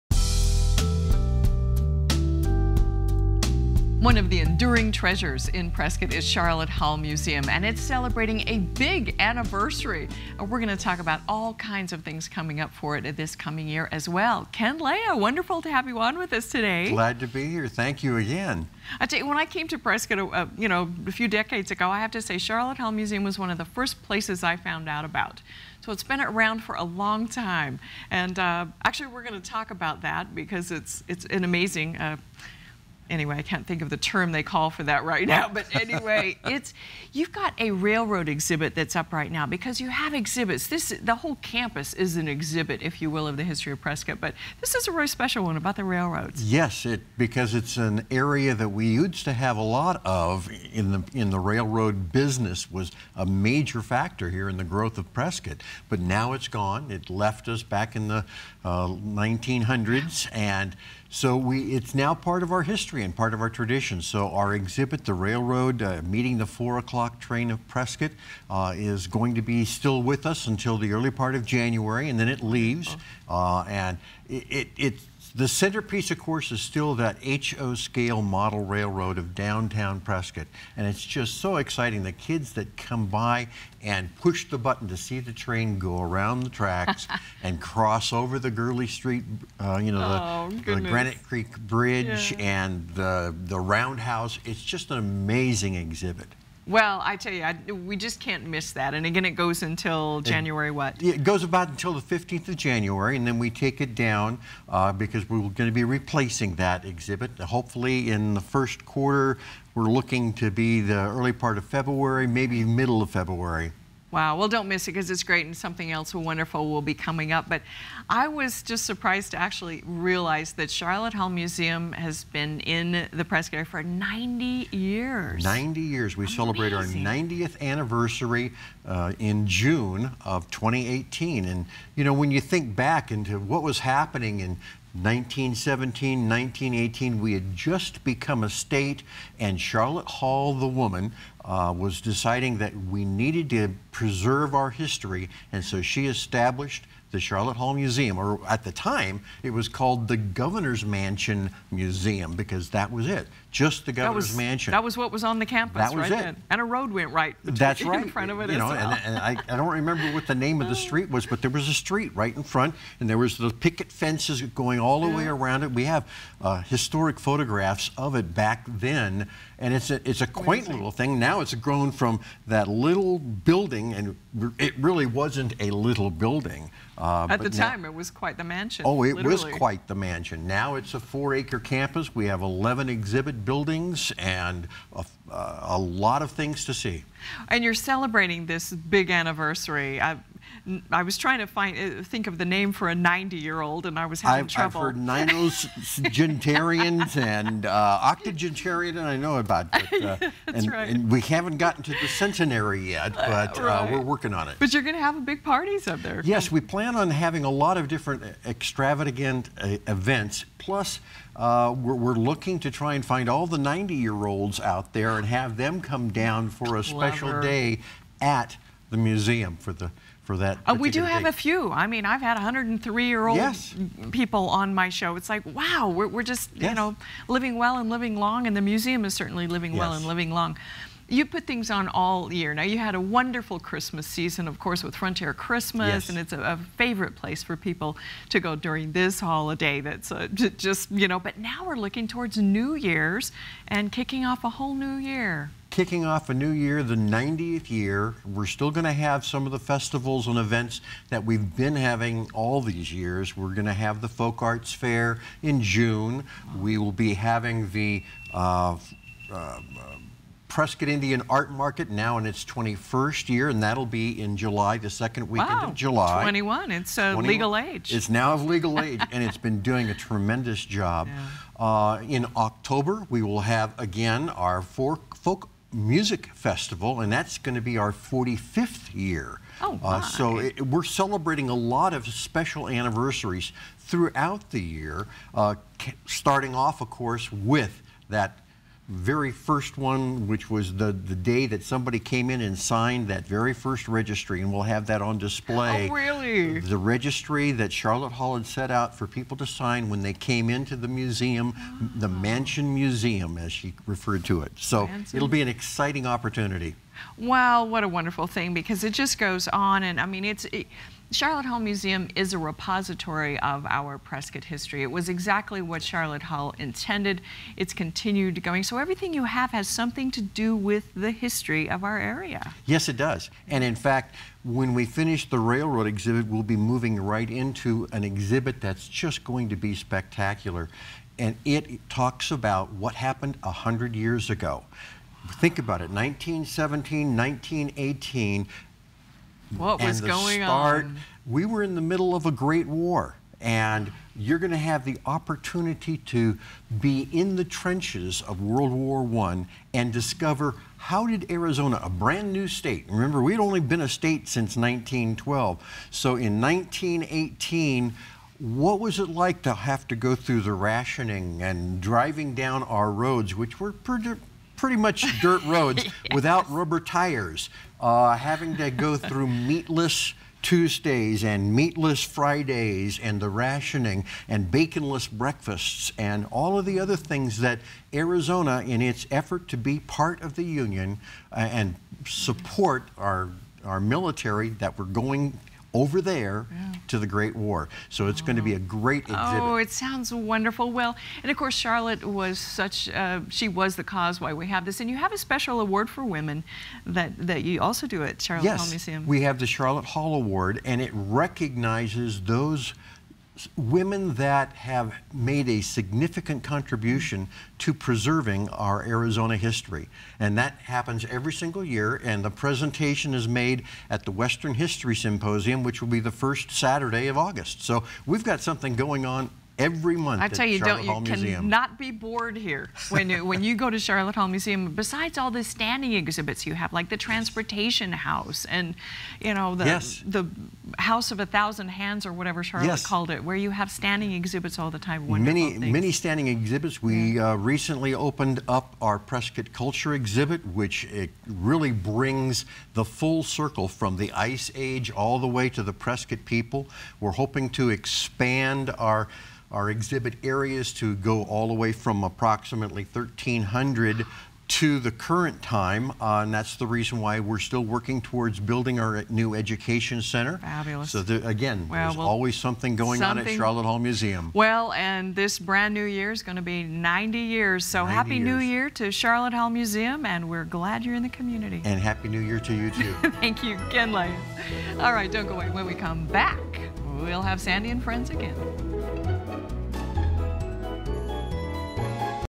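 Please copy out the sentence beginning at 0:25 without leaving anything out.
So it's been around for a long time, and uh, actually, we're going to talk about that because it's it's an amazing.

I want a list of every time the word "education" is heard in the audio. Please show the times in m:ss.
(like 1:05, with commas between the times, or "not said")
7:39.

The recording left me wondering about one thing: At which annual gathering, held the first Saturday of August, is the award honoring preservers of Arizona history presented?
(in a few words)
Western History Symposium.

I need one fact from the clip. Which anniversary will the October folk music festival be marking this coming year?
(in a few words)
45th.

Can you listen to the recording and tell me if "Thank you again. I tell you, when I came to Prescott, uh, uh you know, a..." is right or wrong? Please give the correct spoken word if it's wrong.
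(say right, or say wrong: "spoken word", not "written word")
right.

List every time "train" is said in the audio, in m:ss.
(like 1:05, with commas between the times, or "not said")
1:07, 1:25.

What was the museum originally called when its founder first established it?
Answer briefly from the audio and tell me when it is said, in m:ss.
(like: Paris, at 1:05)
Governor's Mansion Museum, at 2:30.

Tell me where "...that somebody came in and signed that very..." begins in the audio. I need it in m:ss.
4:51.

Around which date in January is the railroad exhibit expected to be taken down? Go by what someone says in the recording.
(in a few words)
15th of January.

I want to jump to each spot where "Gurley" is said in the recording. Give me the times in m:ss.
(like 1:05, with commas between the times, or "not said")
1:28.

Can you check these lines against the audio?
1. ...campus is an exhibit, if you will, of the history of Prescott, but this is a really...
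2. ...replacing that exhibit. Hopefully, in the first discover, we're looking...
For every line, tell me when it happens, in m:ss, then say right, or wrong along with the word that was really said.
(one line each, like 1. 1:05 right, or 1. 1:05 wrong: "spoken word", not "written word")
1. 0:41 right
2. 1:45 wrong: "quarter", not "discover".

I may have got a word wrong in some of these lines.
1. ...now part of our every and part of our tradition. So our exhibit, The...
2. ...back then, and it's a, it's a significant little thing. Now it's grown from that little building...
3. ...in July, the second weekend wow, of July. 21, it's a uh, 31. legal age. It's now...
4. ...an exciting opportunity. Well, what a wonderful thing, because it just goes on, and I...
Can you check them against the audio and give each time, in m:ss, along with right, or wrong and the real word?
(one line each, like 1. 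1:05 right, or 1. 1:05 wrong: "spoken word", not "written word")
1. 1:01 wrong: "history", not "every"
2. 2:48 wrong: "quaint", not "significant"
3. 4:24 wrong: "21", not "31"
4. 5:05 right.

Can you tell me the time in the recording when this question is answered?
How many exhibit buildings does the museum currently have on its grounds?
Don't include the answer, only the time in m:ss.
3:02.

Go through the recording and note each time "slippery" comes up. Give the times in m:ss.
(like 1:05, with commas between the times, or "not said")
not said.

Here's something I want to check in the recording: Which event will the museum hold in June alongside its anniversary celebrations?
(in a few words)
Folk Arts Fair.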